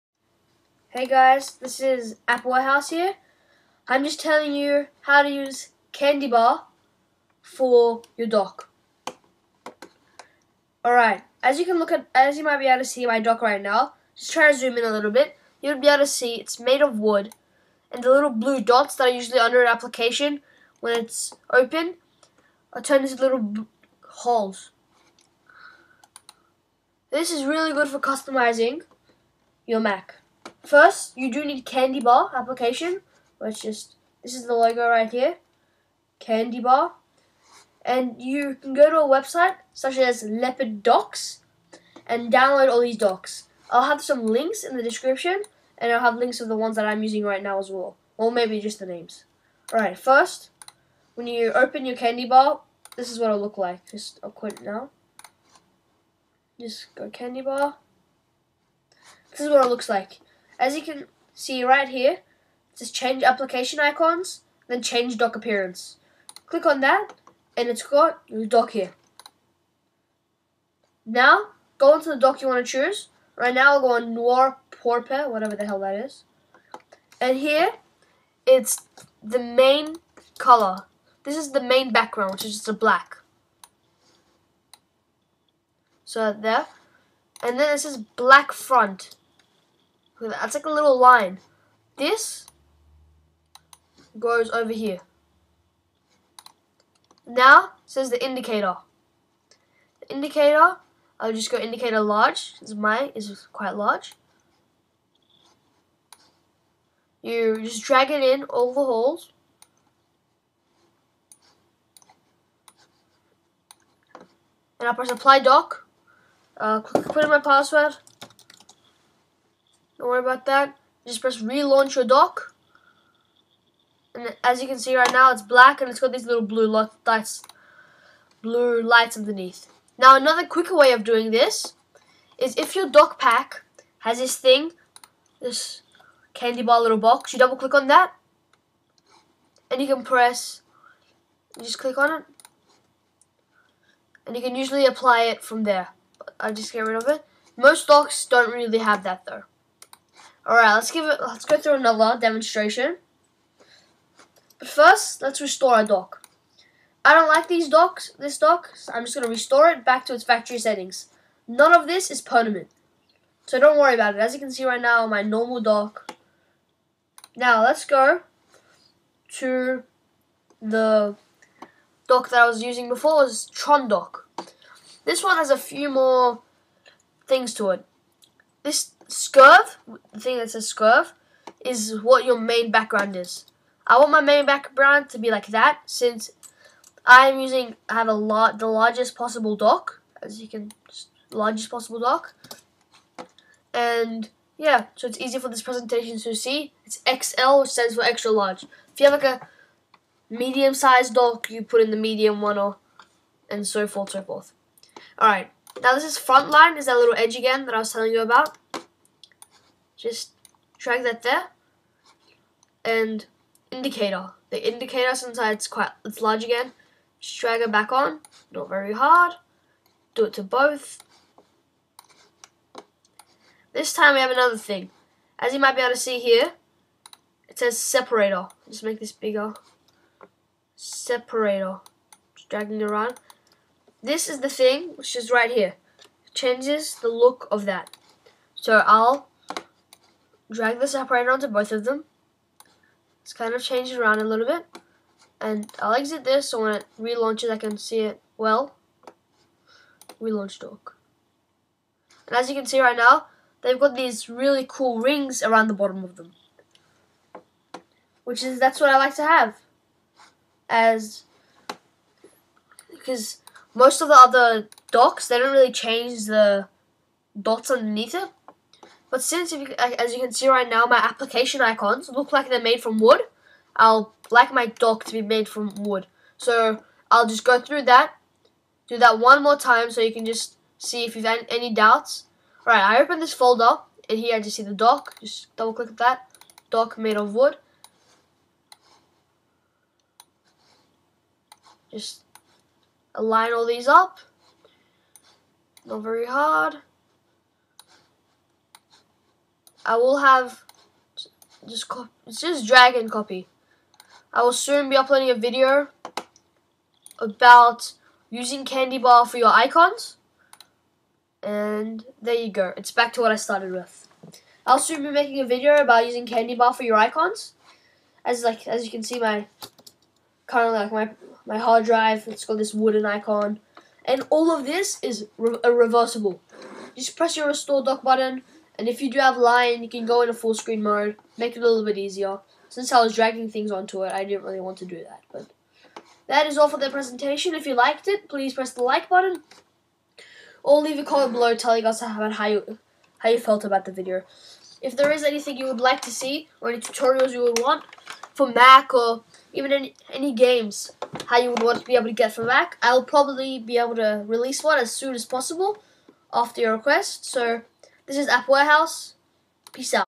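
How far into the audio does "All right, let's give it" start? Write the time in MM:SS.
02:30.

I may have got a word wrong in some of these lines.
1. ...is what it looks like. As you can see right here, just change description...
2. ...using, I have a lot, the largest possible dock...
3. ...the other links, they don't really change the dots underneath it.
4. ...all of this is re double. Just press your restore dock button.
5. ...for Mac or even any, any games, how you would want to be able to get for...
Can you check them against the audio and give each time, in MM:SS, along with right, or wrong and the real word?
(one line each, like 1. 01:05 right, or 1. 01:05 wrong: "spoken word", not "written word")
1. 00:59 wrong: "application", not "description"
2. 03:07 right
3. 04:24 wrong: "docks", not "links"
4. 05:24 wrong: "reversible", not "double"
5. 05:48 right.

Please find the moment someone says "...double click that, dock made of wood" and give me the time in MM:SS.
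04:45.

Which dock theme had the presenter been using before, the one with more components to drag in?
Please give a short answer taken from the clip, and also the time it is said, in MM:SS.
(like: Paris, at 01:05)
Tron dock, at 02:53.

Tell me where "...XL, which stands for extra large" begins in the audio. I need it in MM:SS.
03:17.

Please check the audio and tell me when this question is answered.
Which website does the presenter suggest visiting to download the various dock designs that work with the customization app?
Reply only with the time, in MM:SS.
00:40.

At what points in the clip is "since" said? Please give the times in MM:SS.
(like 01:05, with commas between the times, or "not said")
03:05, 03:35, 04:29, 05:32.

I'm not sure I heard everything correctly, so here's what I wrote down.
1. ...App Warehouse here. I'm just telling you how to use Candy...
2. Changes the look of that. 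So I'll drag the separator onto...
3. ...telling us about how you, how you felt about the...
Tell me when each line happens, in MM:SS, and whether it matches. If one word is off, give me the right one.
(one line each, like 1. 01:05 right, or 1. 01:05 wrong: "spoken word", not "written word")
1. 00:02 right
2. 03:56 right
3. 05:41 right.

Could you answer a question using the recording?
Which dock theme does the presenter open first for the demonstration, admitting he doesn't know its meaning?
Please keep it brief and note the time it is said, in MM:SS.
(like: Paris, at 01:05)
Noir Pourpre, at 01:14.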